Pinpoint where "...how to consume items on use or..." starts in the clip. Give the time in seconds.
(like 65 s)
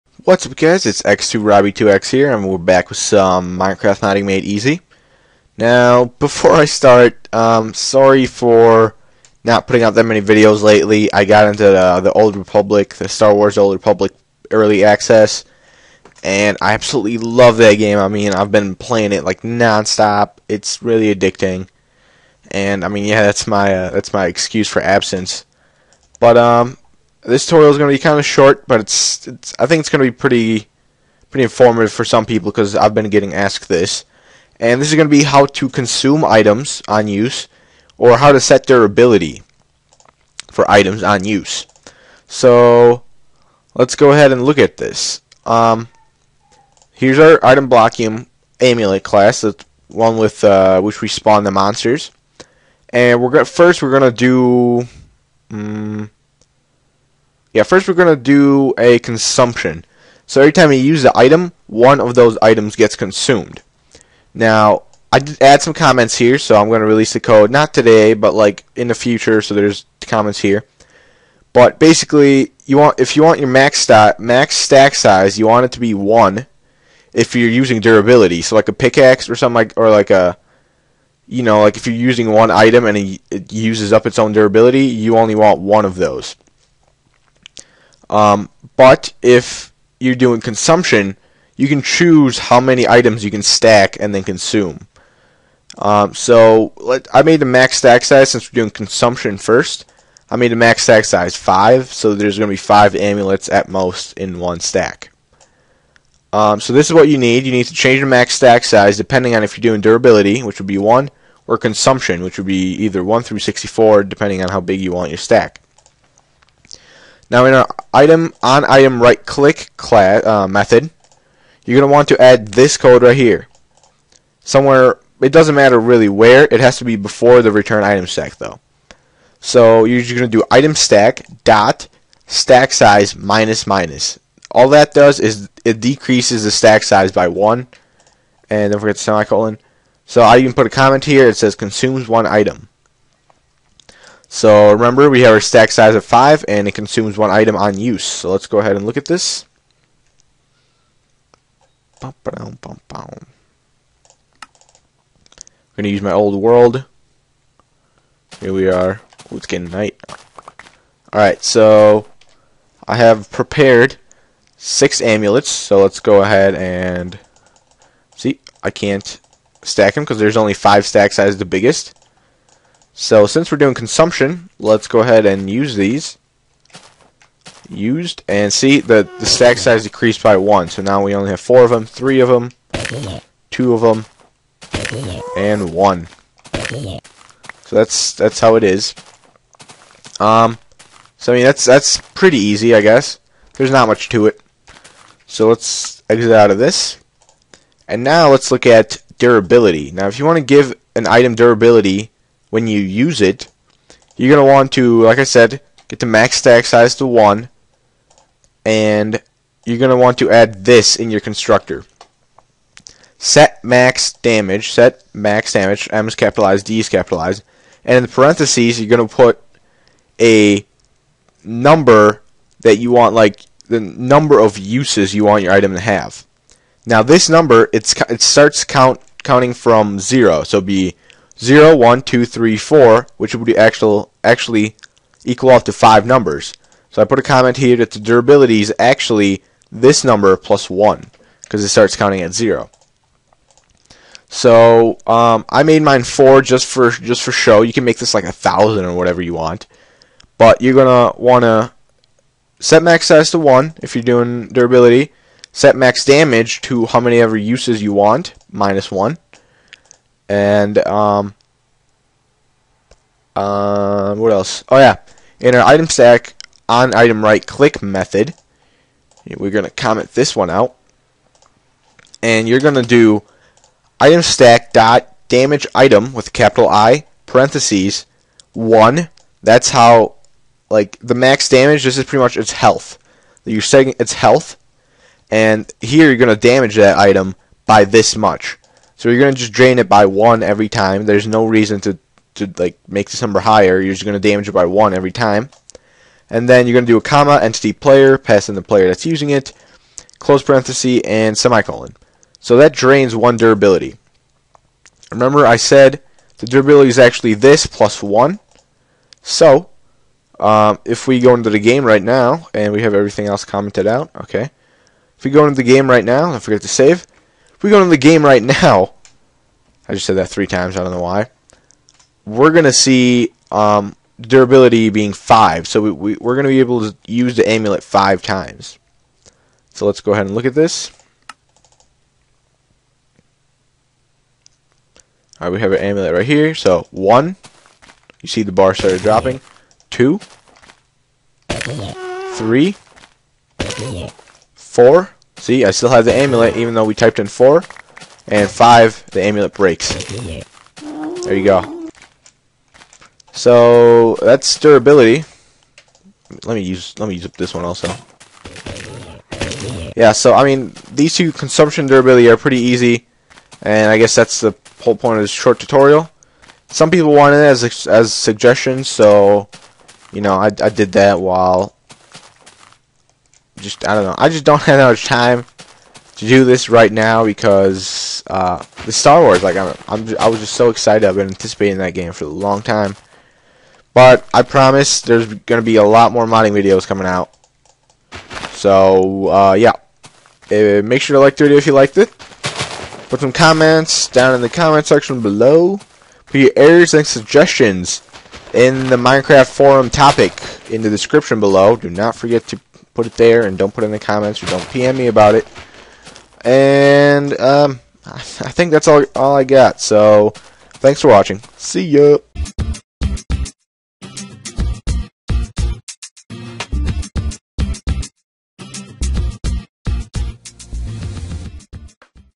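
35 s.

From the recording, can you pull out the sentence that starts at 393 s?
Put some comments down in the comment section below.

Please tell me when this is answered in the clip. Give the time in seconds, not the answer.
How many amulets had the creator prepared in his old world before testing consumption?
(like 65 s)
164 s.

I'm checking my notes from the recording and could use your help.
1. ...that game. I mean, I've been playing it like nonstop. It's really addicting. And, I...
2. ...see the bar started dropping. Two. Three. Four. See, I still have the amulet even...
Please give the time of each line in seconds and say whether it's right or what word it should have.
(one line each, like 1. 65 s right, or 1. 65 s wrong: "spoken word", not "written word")
1. 17 s right
2. 338 s right.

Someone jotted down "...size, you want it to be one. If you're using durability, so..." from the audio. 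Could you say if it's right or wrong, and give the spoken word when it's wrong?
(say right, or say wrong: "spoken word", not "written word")
right.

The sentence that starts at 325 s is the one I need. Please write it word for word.
So we, we, we're going to be able to use the amulet 5 times.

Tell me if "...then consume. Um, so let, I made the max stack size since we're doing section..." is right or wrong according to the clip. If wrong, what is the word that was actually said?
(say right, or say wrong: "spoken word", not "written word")
wrong: "consumption", not "section".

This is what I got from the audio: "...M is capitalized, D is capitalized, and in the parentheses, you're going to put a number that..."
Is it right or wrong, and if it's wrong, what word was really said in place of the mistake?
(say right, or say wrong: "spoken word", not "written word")
right.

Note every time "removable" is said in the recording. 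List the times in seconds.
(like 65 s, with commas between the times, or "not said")
not said.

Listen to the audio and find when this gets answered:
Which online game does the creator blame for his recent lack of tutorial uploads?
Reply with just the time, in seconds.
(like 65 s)
13 s.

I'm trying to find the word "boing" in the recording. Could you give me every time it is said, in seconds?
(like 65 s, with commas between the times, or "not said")
not said.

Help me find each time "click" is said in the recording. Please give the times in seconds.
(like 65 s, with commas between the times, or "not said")
119 s, 267 s.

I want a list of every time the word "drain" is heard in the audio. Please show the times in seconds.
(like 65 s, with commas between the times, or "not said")
289 s, 302 s.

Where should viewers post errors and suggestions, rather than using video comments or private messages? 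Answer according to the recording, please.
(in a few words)
Minecraft forum topic.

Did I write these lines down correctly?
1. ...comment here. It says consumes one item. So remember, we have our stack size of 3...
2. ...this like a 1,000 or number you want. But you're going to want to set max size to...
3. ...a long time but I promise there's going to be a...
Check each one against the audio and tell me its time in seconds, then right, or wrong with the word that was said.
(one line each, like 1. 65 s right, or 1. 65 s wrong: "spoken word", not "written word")
1. 140 s wrong: "5", not "3"
2. 247 s wrong: "whatever", not "number"
3. 382 s right.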